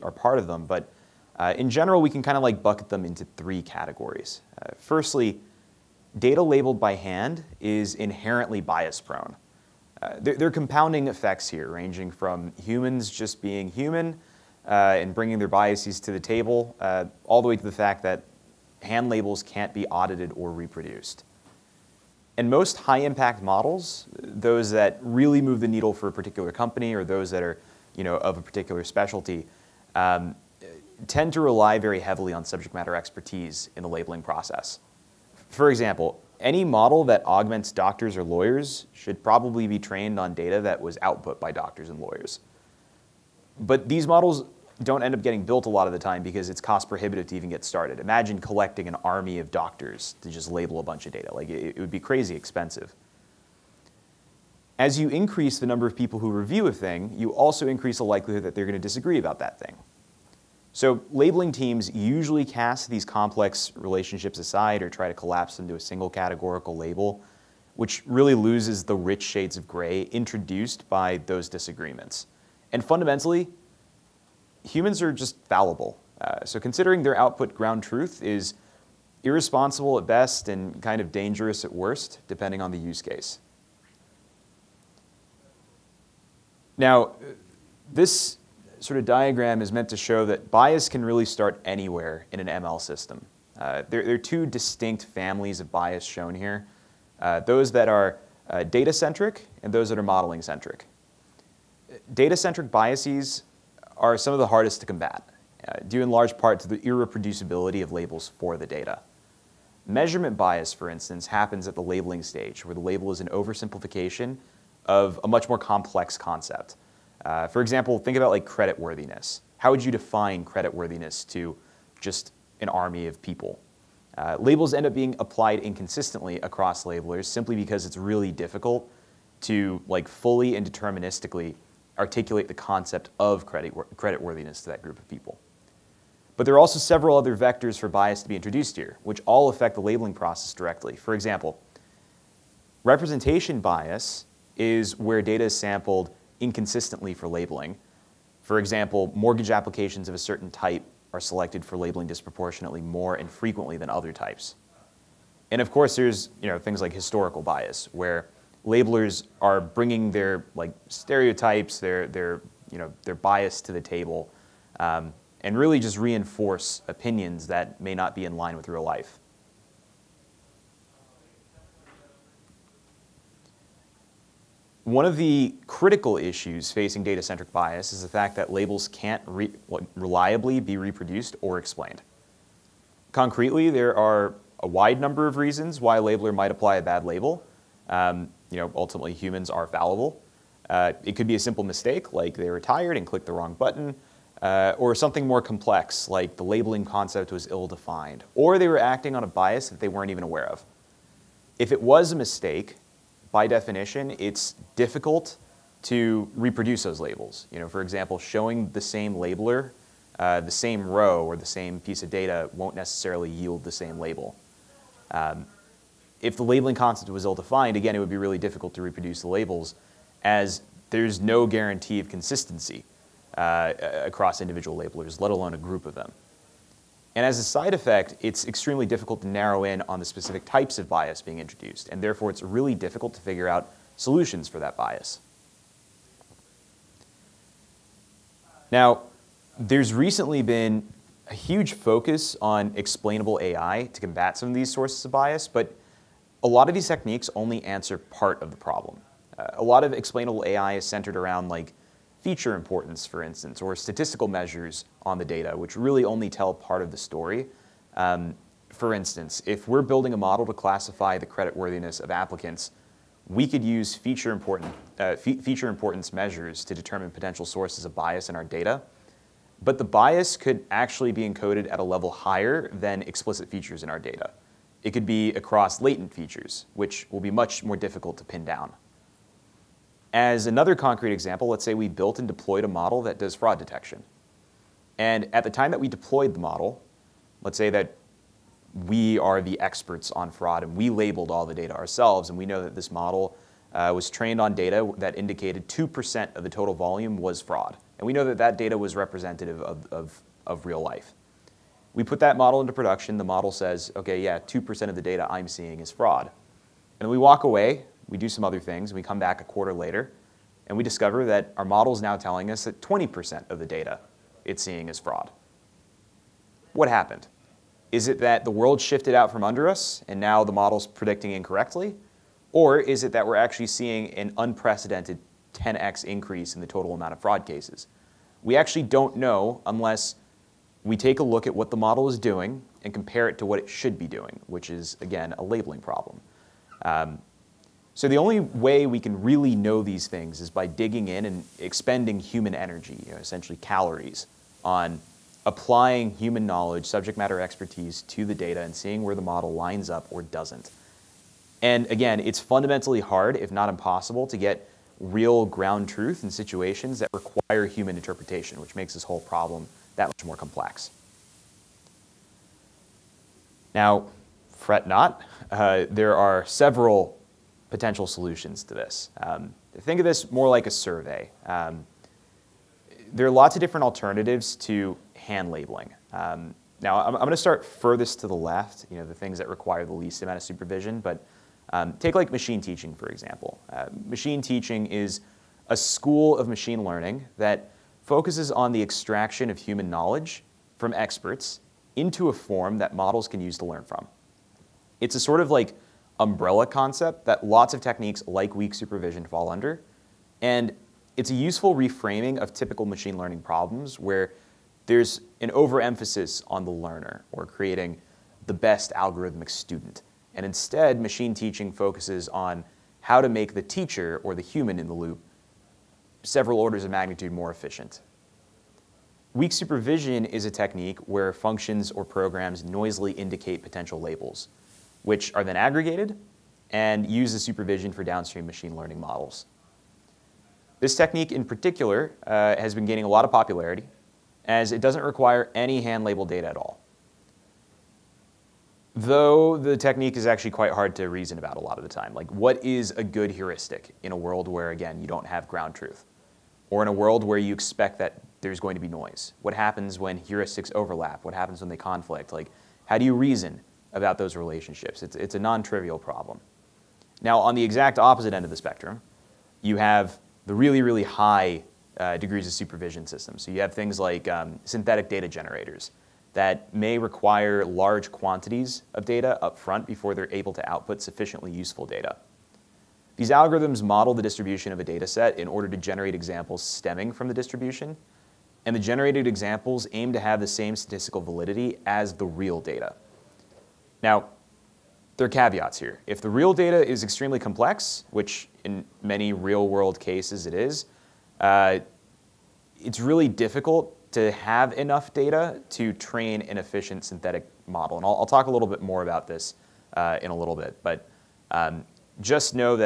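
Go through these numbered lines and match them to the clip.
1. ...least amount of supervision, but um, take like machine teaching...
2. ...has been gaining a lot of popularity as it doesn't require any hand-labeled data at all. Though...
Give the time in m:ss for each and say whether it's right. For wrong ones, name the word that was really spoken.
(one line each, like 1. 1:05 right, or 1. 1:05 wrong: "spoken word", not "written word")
1. 6:19 right
2. 7:12 right.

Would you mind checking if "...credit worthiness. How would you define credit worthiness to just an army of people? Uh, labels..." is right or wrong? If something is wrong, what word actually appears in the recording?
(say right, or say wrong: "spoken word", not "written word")
right.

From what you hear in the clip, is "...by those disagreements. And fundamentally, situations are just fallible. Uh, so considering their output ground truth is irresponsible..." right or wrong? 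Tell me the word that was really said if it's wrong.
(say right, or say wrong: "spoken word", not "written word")
wrong: "humans", not "situations".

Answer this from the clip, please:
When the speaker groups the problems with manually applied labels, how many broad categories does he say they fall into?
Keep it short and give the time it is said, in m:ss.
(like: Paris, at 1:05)
3, at 0:03.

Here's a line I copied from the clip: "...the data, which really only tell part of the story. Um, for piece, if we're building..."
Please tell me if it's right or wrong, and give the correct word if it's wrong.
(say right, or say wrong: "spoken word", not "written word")
wrong: "instance", not "piece".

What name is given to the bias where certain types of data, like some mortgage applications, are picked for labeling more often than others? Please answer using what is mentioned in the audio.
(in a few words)
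Representation bias.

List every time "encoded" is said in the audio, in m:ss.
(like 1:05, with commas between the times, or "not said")
4:31.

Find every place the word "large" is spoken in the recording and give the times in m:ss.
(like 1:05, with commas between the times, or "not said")
1:46, 7:47.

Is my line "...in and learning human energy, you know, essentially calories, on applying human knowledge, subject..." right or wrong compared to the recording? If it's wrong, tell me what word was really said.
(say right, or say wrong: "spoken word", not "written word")
wrong: "expending", not "learning".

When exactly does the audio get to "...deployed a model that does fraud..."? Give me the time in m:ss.
4:42.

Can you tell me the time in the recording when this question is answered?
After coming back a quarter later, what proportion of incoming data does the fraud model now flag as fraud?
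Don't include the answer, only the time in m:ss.
5:12.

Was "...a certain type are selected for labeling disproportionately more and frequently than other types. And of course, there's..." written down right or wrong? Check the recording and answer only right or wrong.
right.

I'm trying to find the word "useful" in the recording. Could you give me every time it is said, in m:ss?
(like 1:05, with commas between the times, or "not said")
6:41, 7:51.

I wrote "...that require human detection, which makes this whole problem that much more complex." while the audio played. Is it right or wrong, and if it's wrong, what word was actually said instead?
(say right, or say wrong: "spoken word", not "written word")
wrong: "interpretation", not "detection".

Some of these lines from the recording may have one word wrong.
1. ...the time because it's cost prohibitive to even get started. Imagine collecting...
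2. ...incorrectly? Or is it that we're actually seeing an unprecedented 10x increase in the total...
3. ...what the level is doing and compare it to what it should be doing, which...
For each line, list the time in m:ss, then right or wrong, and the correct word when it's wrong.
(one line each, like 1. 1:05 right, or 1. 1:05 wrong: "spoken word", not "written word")
1. 0:45 right
2. 5:21 right
3. 5:31 wrong: "model", not "level".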